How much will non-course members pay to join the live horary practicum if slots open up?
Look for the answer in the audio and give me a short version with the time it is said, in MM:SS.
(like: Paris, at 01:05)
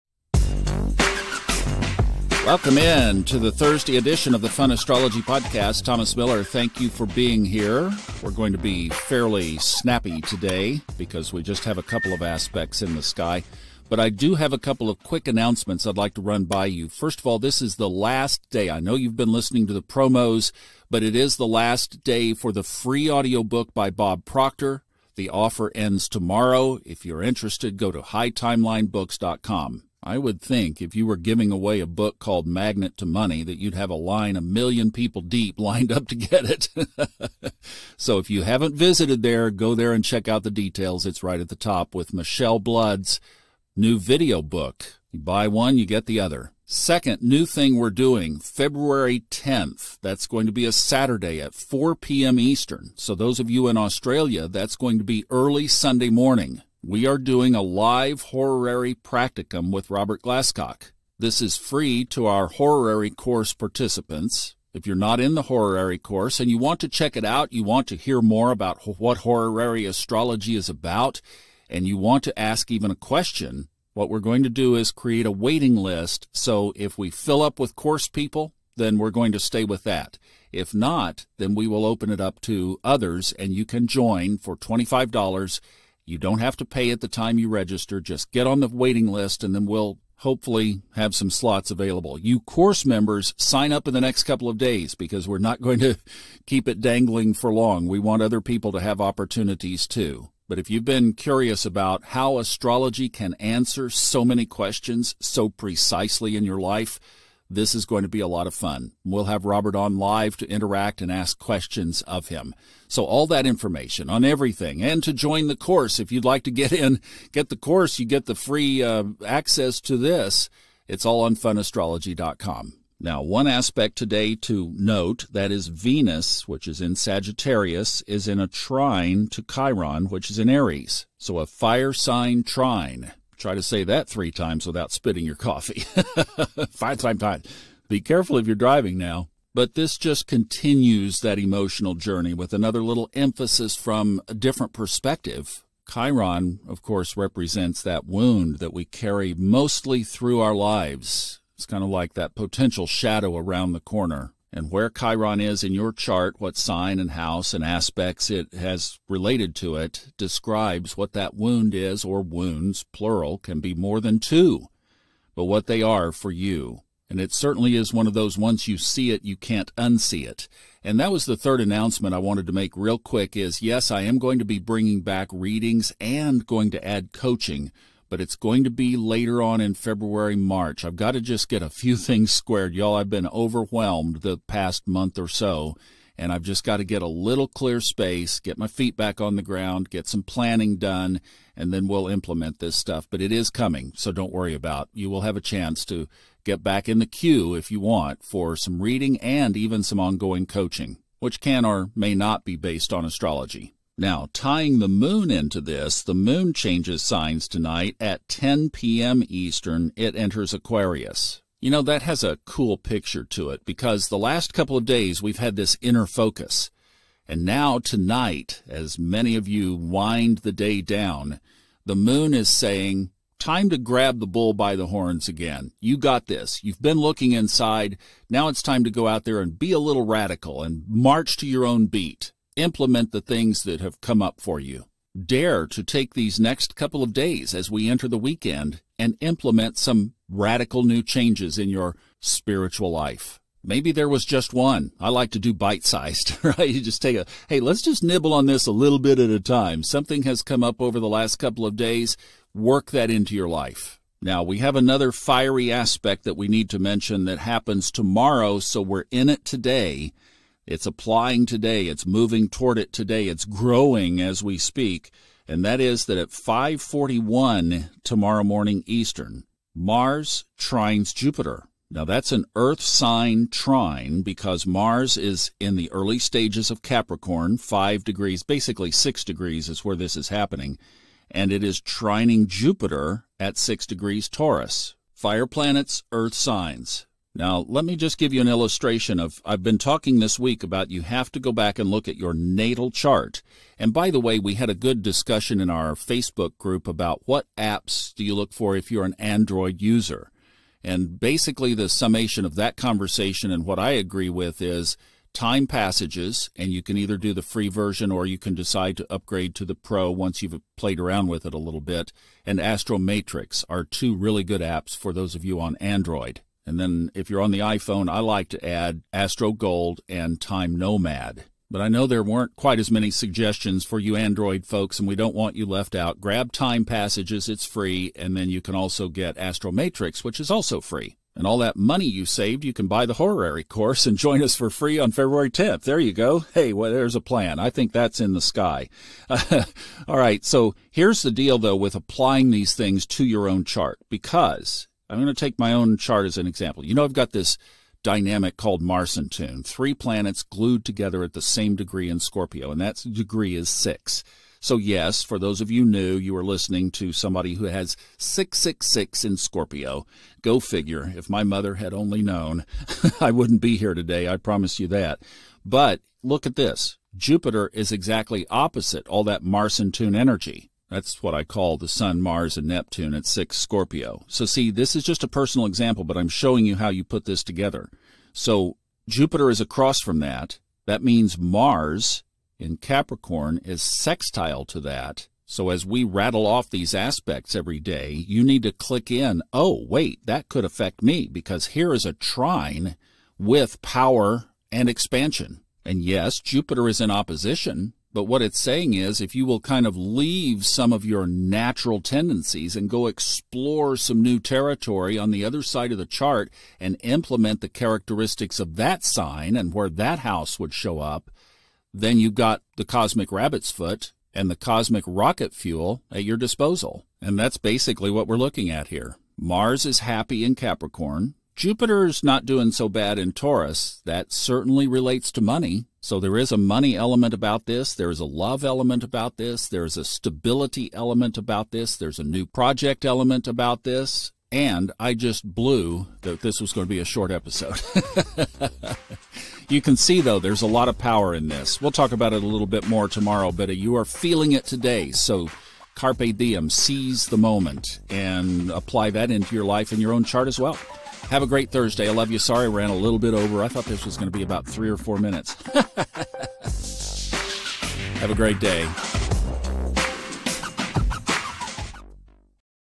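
$25, at 01:24.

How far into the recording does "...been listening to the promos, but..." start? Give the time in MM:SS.
00:19.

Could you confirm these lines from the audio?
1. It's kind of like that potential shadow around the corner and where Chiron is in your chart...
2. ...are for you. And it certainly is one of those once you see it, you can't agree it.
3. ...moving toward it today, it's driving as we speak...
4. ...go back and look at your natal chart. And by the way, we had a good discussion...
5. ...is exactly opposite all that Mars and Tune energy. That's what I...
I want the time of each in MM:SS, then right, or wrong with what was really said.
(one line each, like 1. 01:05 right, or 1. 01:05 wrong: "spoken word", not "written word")
1. 02:31 right
2. 02:45 wrong: "unsee", not "agree"
3. 04:22 wrong: "growing", not "driving"
4. 04:51 right
5. 06:07 right.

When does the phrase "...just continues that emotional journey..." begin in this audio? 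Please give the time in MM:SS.
02:19.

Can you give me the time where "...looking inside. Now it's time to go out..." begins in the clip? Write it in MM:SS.
03:46.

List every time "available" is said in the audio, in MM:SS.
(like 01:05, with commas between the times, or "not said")
01:31.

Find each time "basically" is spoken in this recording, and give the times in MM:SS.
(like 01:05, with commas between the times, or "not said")
04:38, 05:01, 06:57.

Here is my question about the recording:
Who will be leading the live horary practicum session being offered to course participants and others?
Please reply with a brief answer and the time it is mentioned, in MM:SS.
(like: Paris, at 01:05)
Robert Glasscock, at 00:59.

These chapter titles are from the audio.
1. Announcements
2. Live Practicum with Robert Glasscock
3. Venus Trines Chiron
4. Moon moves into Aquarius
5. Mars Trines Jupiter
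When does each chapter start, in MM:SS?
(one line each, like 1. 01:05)
1. 00:15
2. 00:46
3. 02:02
4. 03:24
5. 04:14.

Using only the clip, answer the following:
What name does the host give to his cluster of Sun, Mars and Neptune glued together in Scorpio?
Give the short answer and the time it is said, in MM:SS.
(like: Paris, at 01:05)
Marsentune, at 05:48.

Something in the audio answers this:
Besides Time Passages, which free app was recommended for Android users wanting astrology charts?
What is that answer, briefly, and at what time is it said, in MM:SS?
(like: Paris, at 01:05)
Astromatrix, at 05:12.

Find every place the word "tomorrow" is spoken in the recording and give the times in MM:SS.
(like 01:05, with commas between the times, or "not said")
00:26, 04:17, 04:28, 07:23.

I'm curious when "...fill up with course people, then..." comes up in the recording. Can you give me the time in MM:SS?
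01:17.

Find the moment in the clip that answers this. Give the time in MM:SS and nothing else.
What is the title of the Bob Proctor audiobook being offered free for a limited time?
00:32.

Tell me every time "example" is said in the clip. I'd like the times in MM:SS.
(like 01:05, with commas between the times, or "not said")
05:46, 06:15.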